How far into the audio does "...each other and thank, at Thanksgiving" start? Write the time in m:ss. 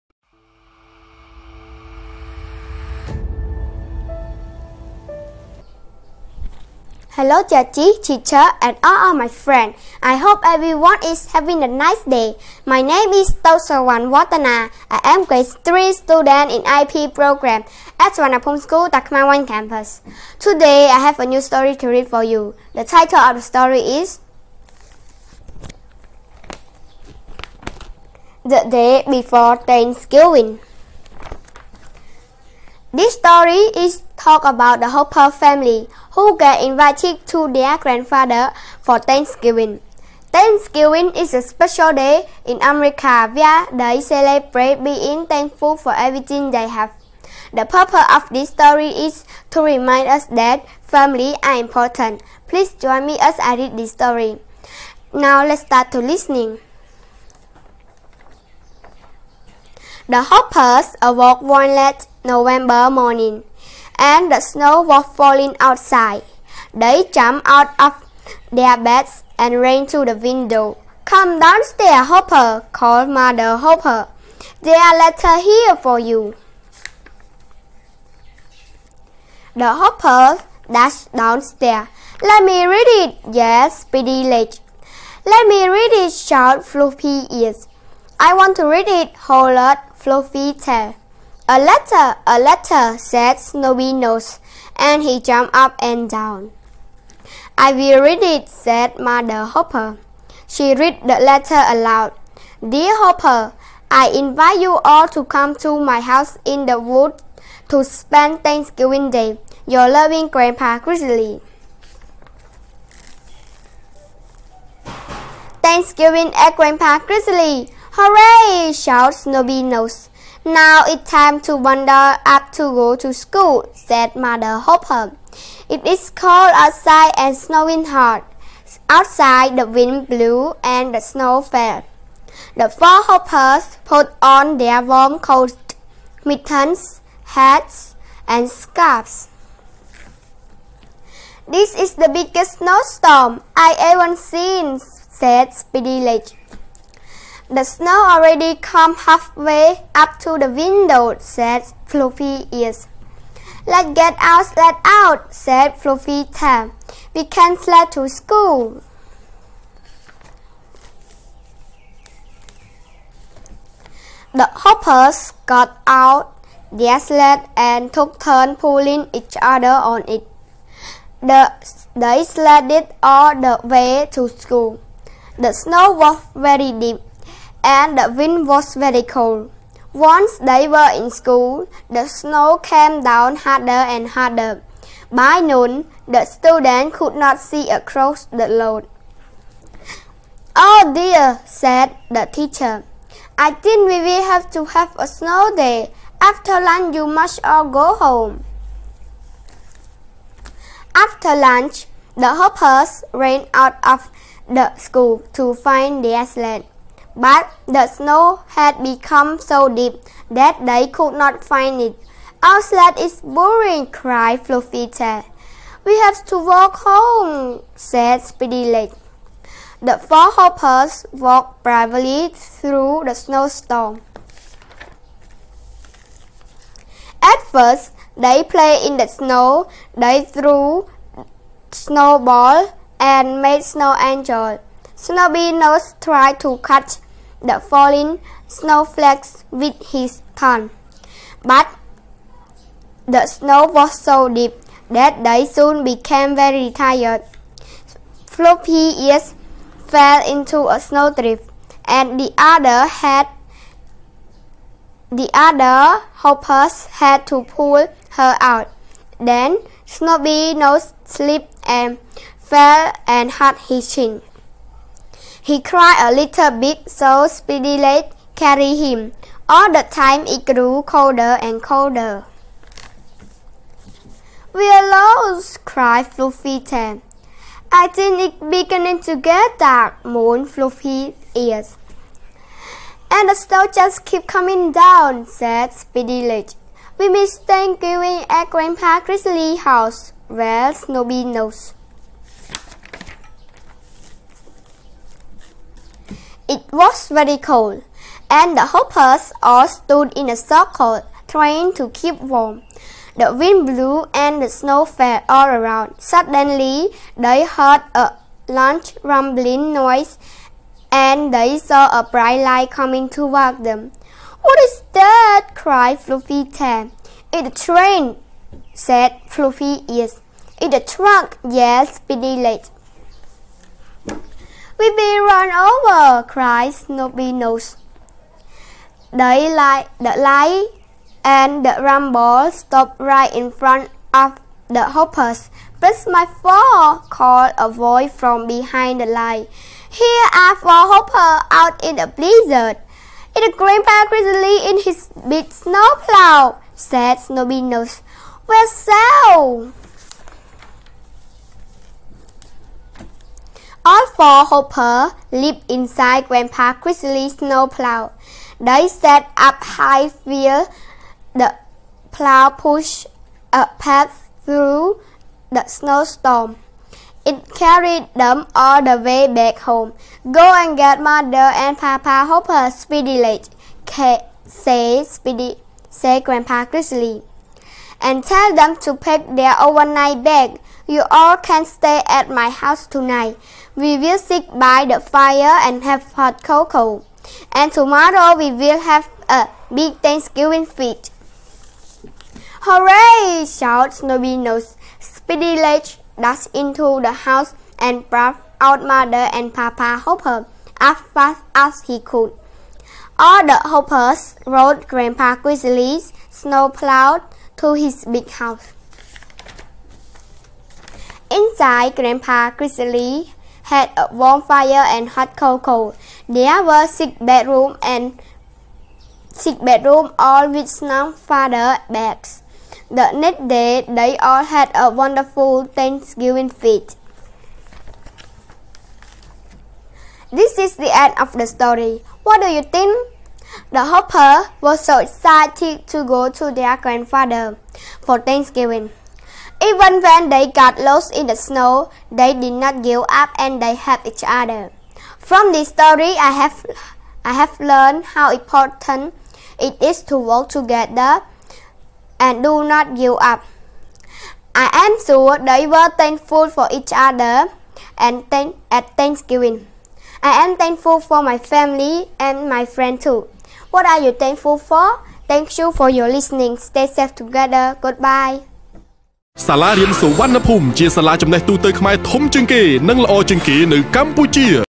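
7:36.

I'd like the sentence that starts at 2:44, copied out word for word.
The hoppers got out their sled and took turns pulling each other on it.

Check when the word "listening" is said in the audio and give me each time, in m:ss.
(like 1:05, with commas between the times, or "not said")
0:55, 7:46.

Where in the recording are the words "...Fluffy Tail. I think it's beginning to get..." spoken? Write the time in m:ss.
4:36.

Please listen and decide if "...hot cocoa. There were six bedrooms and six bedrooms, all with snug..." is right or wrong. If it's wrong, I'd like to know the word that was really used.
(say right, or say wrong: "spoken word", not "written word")
right.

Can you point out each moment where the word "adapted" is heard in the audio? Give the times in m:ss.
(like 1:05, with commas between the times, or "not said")
not said.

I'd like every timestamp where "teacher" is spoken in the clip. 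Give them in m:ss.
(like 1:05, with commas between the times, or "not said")
0:08, 3:12.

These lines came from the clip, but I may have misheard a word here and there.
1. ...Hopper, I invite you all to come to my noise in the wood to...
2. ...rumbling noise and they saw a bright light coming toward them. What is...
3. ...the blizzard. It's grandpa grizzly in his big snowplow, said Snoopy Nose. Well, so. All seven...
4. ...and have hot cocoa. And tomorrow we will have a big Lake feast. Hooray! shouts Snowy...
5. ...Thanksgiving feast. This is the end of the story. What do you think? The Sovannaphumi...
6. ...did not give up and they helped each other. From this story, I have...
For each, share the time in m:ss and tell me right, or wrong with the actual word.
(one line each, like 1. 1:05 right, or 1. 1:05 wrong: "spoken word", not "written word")
1. 1:43 wrong: "house", not "noise"
2. 5:09 right
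3. 5:42 wrong: "four", not "seven"
4. 6:25 wrong: "Thanksgiving", not "Lake"
5. 7:05 wrong: "Hopper", not "Sovannaphumi"
6. 7:22 right.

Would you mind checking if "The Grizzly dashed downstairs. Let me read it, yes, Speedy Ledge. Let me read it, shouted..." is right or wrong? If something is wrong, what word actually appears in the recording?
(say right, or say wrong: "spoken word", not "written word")
wrong: "Hopper", not "Grizzly".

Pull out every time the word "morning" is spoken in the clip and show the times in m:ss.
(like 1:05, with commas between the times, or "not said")
1:02.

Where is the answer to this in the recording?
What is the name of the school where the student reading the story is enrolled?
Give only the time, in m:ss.
0:18.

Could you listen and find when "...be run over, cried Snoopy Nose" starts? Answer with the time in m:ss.
5:24.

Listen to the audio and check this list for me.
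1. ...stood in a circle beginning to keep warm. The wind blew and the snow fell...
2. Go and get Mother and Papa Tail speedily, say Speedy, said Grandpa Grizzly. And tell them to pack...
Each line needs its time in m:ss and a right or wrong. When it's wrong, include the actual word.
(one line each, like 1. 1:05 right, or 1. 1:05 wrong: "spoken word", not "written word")
1. 4:59 wrong: "trying", not "beginning"
2. 6:10 wrong: "Hopper", not "Tail".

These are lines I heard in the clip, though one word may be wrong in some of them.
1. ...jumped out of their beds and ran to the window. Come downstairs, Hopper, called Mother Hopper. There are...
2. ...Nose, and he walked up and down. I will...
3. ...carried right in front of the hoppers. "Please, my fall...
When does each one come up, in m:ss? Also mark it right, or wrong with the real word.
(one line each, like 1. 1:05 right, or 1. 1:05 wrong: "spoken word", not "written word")
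1. 1:07 right
2. 1:33 wrong: "jumped", not "walked"
3. 5:32 wrong: "stopped", not "carried".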